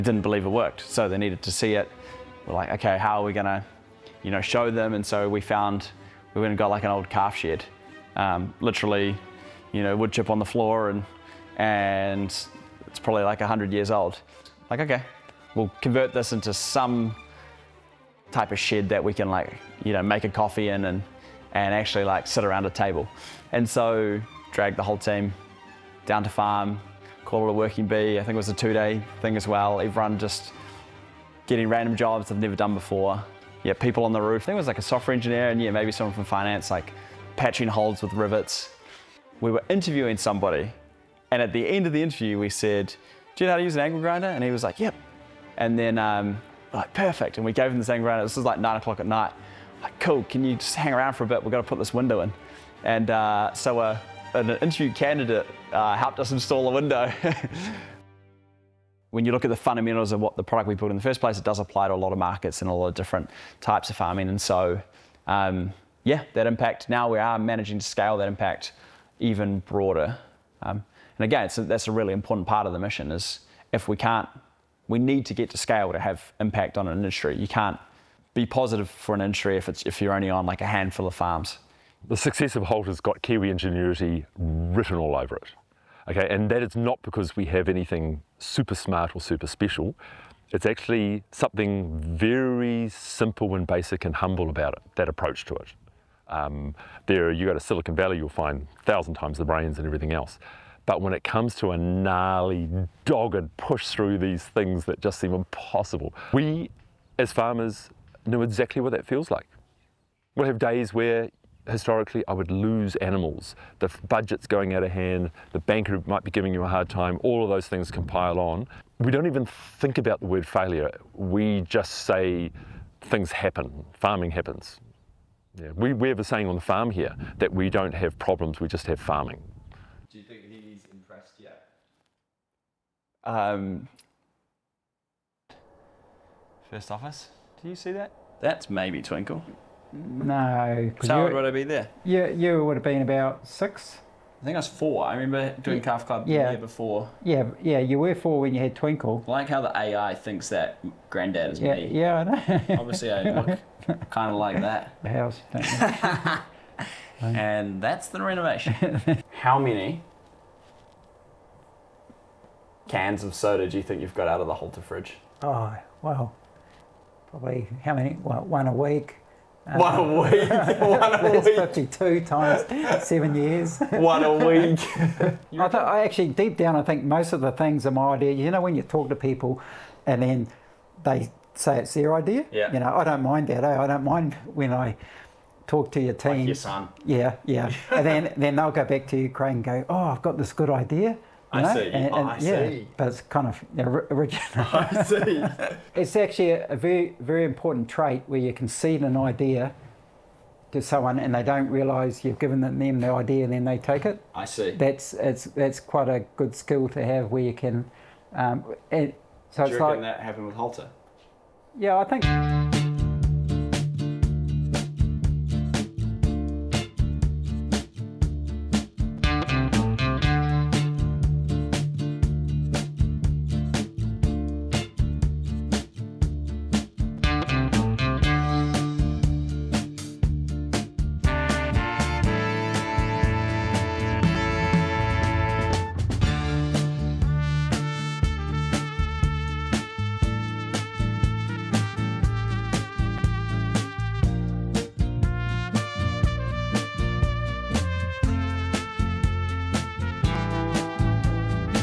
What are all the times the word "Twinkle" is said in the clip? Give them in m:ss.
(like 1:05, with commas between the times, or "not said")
2:19, 2:28.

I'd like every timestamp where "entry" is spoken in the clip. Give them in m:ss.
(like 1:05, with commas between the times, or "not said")
1:19.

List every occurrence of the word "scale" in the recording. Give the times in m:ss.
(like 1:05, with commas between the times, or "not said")
1:07, 1:15.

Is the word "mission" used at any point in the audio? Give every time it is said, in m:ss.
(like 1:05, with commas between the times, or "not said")
1:12.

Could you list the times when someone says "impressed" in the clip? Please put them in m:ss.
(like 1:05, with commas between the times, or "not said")
2:10.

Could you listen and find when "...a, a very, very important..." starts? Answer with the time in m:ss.
3:16.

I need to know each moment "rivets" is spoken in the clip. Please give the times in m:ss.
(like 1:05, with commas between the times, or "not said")
0:38.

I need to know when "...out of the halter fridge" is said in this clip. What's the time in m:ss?
2:44.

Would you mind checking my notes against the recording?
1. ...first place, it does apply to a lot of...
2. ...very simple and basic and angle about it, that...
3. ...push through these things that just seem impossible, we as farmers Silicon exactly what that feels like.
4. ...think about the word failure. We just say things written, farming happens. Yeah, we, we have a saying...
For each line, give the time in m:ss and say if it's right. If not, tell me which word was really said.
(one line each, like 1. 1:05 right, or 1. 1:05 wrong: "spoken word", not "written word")
1. 1:01 right
2. 1:32 wrong: "humble", not "angle"
3. 1:43 wrong: "Know", not "Silicon"
4. 1:59 wrong: "happen", not "written".